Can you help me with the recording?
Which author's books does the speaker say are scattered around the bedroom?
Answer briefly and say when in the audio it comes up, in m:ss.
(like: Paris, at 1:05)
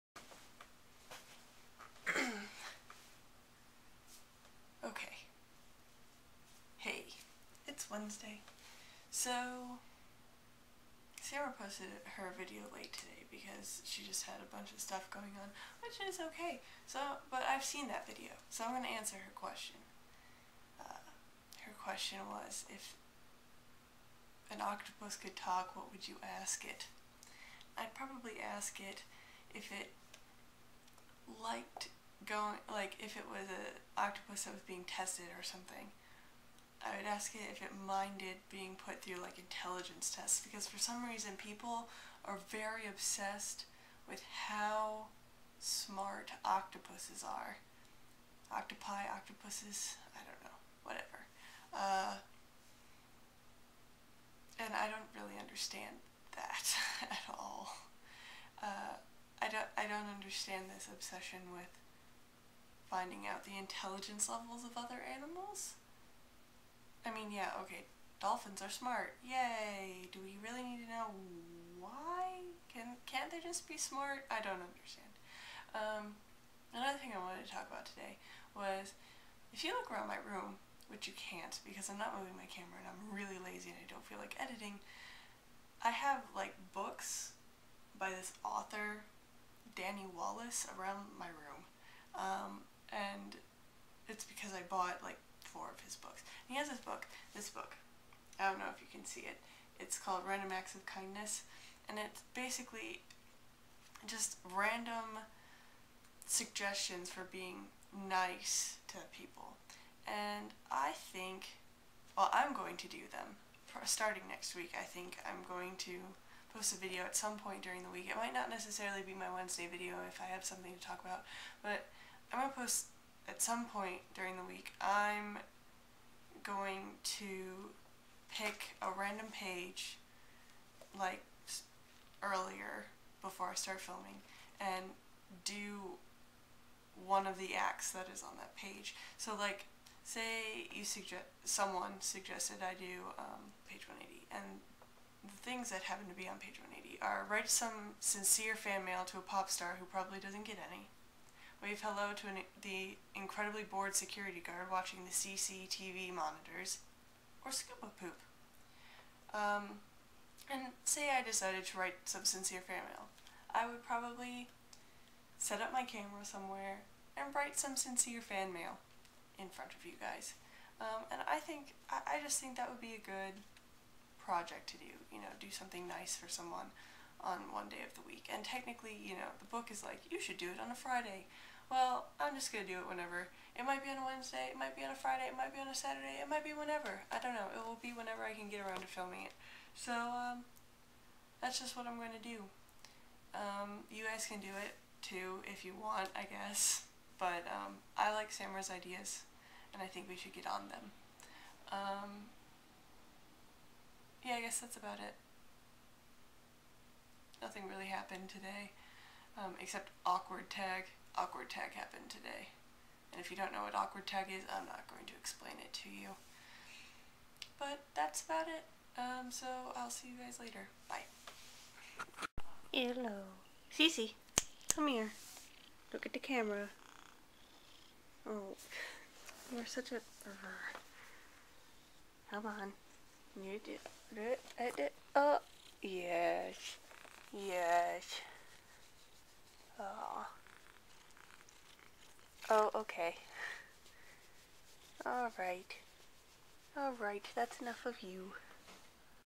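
Danny Wallace, at 1:29.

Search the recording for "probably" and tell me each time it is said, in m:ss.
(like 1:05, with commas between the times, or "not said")
0:27, 2:29, 2:43.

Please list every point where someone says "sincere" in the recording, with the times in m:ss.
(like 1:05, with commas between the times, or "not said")
2:27, 2:42, 2:47.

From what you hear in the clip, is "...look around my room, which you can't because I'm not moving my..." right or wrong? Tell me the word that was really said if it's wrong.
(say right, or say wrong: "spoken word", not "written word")
right.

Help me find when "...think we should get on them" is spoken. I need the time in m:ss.
3:19.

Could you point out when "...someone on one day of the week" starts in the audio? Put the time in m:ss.
2:56.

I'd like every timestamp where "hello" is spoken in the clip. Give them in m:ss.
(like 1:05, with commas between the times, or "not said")
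2:31, 3:42.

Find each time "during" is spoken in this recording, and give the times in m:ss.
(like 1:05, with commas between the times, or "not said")
1:57, 2:04.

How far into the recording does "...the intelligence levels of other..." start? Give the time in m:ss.
1:03.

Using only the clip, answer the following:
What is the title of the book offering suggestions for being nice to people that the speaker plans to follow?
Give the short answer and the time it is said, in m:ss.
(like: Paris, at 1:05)
Random Acts of Kindness, at 1:40.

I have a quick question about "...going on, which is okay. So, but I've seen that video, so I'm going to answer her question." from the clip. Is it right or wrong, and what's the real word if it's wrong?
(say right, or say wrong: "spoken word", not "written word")
right.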